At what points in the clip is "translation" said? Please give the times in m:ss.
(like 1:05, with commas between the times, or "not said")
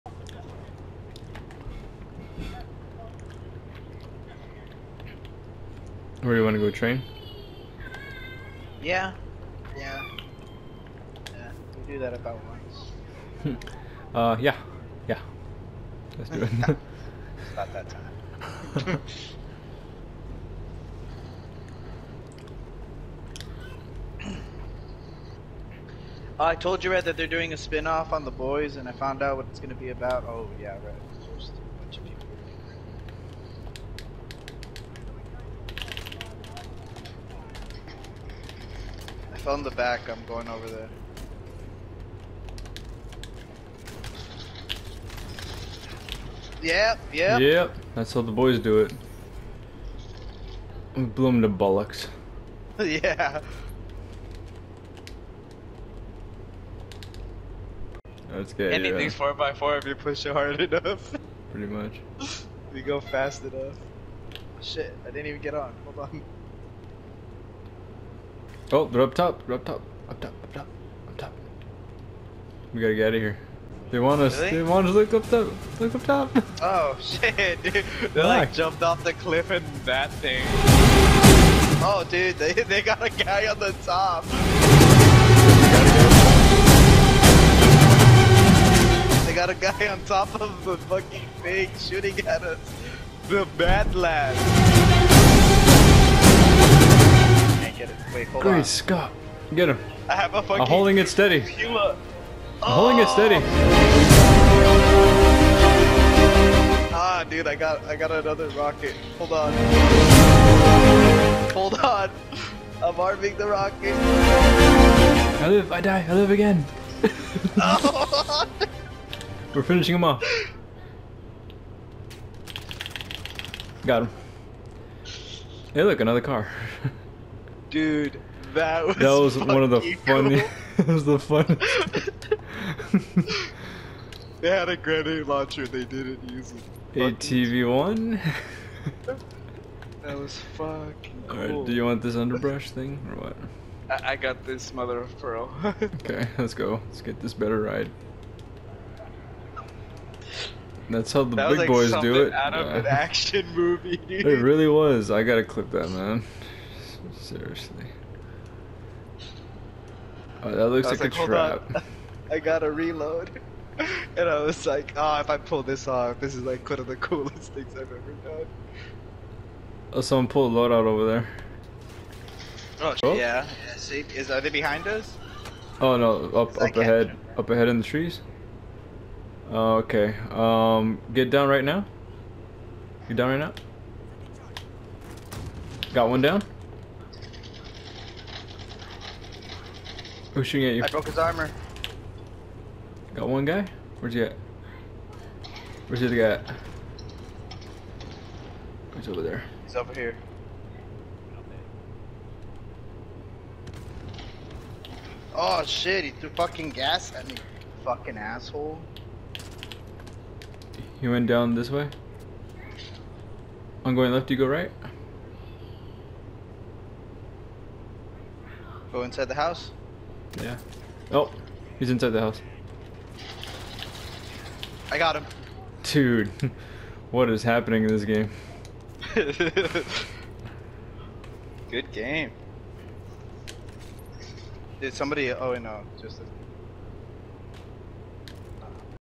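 not said.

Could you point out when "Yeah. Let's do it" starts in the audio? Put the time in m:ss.
0:15.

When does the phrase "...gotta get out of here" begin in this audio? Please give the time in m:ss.
1:12.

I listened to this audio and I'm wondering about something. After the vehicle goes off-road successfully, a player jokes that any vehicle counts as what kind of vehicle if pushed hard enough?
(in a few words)
4x4.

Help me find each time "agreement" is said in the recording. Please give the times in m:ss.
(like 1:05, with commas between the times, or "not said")
not said.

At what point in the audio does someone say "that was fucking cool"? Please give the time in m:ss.
2:20.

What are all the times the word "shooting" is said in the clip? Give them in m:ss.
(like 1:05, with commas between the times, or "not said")
1:31, 3:10.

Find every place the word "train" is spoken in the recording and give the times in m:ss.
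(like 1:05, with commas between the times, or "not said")
0:06.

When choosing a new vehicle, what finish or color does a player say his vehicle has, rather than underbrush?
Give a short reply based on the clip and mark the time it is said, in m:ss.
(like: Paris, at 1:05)
mother of pearl, at 2:24.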